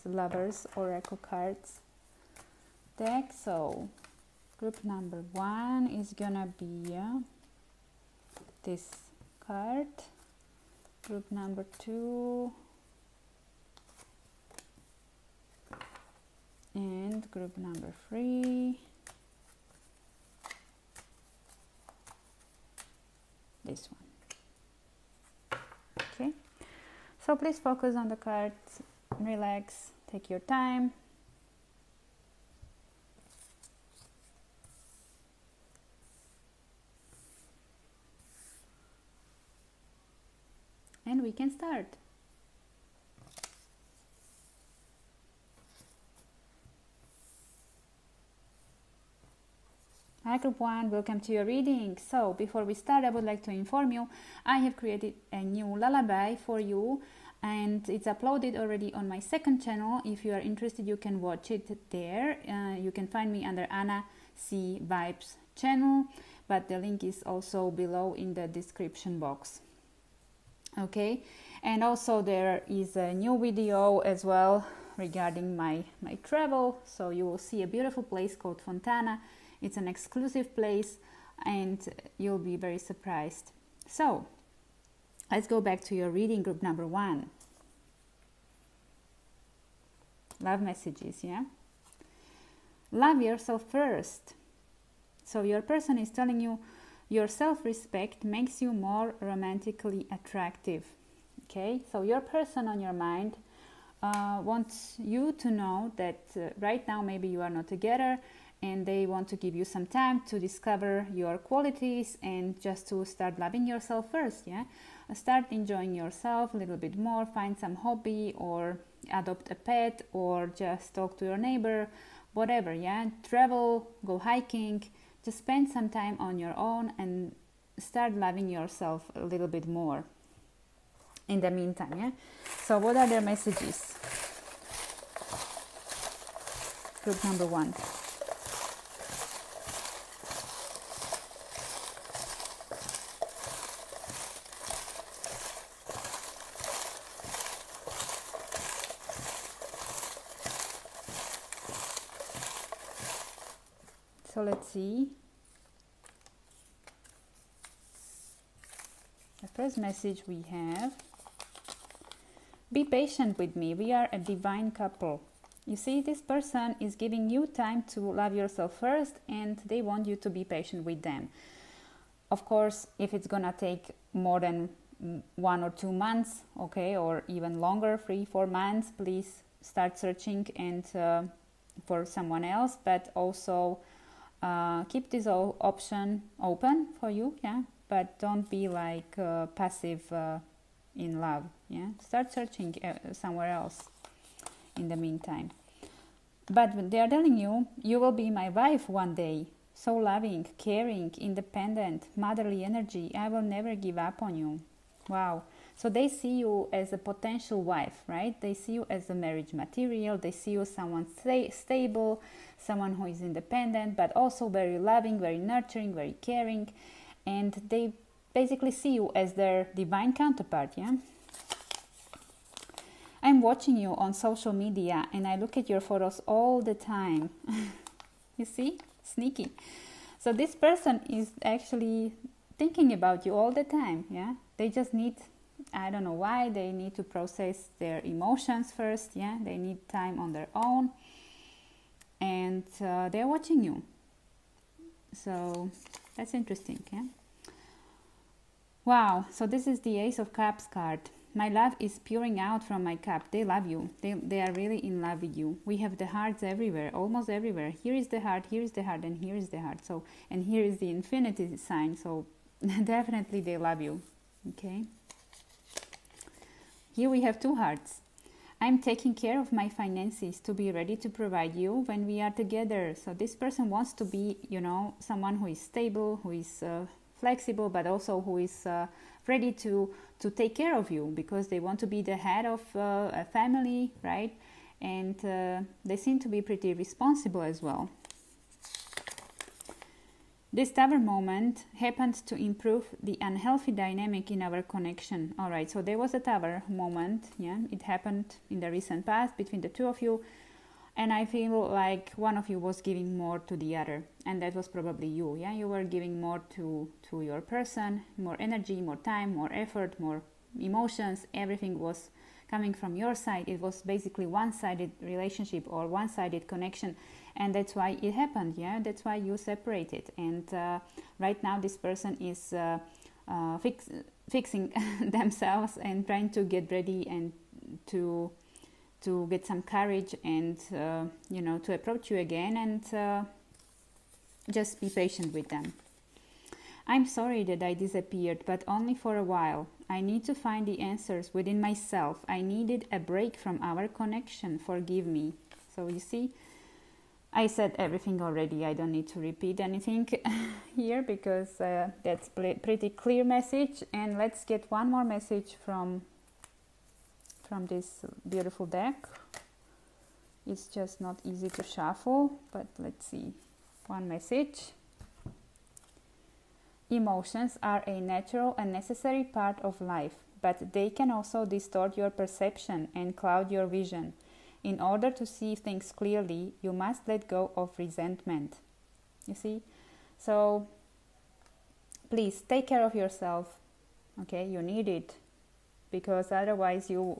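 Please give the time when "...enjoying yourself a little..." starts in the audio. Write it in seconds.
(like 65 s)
115 s.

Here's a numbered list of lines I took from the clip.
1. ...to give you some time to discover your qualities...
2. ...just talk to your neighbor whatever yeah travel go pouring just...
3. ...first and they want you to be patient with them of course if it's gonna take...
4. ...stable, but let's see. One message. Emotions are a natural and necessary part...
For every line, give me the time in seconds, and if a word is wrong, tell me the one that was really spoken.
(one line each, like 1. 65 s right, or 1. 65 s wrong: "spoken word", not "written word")
1. 109 s right
2. 120 s wrong: "hiking", not "pouring"
3. 168 s right
4. 361 s wrong: "shuffle", not "stable".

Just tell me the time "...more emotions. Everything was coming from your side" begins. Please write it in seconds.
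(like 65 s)
310 s.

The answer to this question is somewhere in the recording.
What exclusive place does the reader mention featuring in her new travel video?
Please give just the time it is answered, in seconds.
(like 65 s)
78 s.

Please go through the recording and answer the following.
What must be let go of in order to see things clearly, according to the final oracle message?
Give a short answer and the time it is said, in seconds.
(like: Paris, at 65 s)
Resentment, at 377 s.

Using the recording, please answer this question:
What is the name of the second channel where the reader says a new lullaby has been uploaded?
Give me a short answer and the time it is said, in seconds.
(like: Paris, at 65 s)
Anna C Vibes, at 63 s.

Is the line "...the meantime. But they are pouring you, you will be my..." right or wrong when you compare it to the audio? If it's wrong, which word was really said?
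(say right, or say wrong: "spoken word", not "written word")
wrong: "telling", not "pouring".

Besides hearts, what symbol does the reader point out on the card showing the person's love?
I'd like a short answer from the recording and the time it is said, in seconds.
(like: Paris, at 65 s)
Infinity sign, at 260 s.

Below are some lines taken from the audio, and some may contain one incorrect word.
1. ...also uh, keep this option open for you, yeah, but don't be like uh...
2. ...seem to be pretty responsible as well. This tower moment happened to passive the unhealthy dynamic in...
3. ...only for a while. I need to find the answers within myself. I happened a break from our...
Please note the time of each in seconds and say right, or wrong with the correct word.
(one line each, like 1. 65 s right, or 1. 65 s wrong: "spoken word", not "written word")
1. 183 s right
2. 285 s wrong: "improve", not "passive"
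3. 338 s wrong: "needed", not "happened".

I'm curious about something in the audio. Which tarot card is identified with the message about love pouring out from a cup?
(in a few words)
Ace of Cups.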